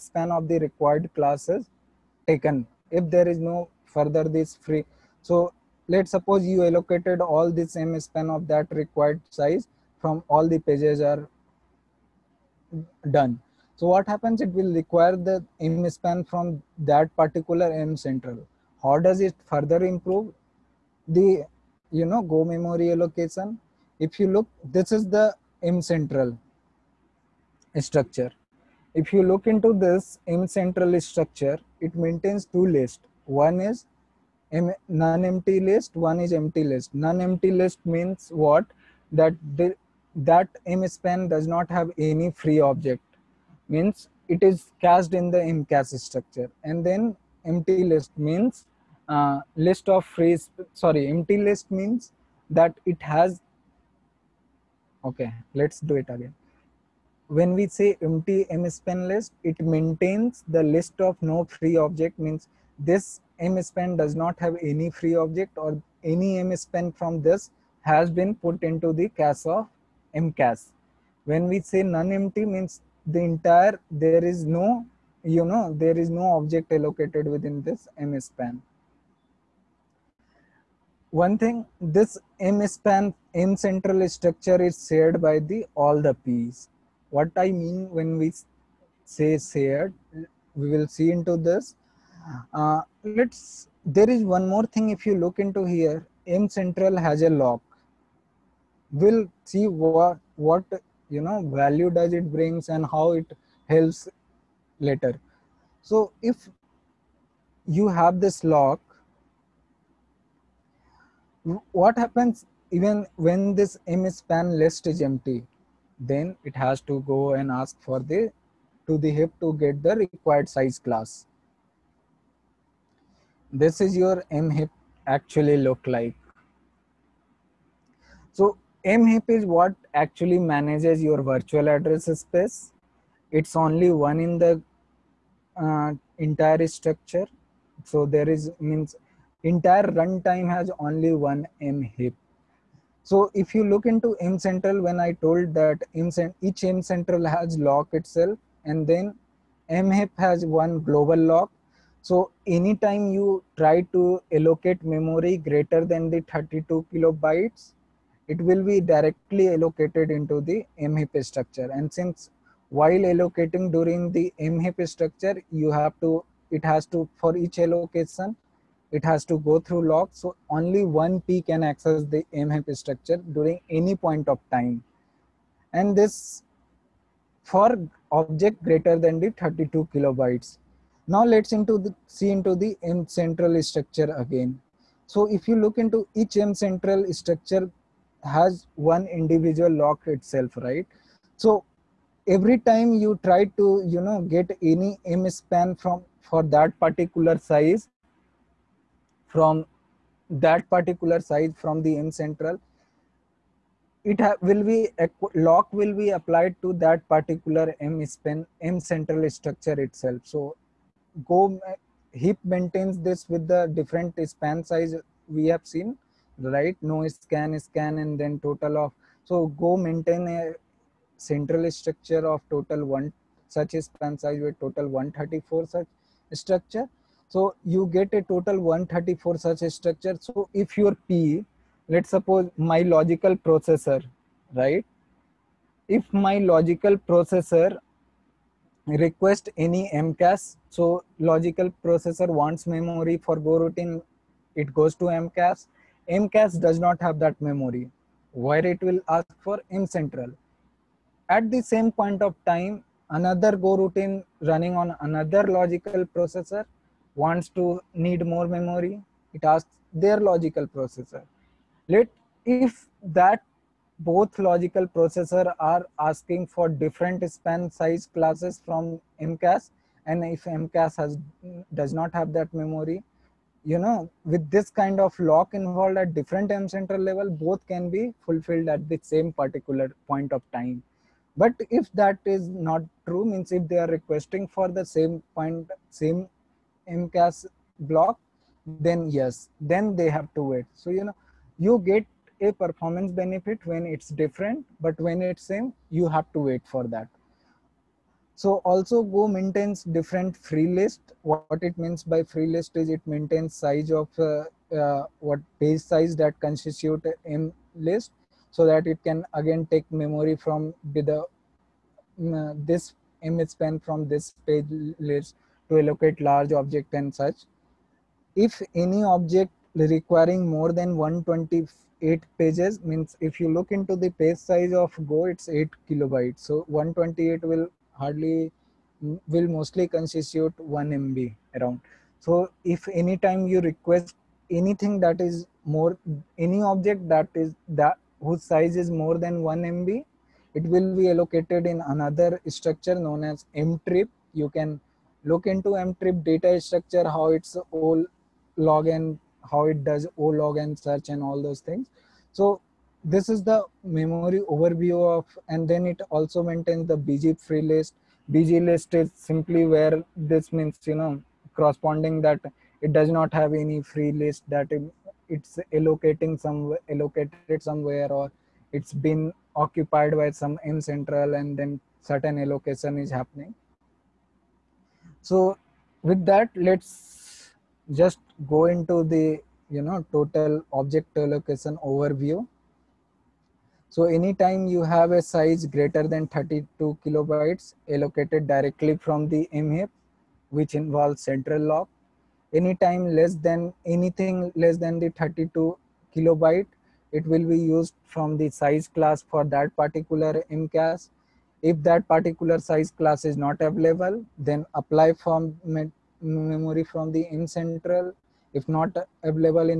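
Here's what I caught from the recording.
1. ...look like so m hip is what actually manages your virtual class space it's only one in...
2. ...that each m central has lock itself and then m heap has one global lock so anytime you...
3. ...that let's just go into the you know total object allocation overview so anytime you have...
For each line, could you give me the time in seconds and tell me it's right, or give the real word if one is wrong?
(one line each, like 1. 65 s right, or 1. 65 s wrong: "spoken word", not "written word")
1. 125 s wrong: "address", not "class"
2. 145 s right
3. 376 s right.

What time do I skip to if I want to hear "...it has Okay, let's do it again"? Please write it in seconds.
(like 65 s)
52 s.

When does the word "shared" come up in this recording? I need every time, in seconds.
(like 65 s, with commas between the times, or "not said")
84 s, 89 s.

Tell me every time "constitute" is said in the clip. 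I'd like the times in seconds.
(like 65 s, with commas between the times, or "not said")
306 s, 329 s.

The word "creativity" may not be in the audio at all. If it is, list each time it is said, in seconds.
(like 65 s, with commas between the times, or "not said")
not said.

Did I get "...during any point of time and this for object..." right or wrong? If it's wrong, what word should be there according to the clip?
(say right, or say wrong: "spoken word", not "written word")
right.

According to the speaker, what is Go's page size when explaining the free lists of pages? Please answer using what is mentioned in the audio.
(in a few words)
8 kilobytes.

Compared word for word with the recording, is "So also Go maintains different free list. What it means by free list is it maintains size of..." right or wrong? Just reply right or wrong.
right.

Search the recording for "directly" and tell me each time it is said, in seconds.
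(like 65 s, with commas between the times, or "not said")
158 s, 388 s.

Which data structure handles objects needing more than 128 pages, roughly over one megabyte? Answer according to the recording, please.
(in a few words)
M treap.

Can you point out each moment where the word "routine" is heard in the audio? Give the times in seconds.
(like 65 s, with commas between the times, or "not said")
243 s, 253 s.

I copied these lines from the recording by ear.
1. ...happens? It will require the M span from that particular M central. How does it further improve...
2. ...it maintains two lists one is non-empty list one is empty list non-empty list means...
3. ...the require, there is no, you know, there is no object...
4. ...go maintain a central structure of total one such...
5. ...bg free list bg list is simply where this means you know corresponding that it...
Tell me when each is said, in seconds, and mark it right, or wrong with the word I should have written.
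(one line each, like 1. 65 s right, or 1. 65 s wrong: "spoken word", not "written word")
1. 14 s right
2. 31 s right
3. 73 s wrong: "entire", not "require"
4. 219 s right
5. 357 s right.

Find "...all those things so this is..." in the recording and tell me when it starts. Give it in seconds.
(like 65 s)
351 s.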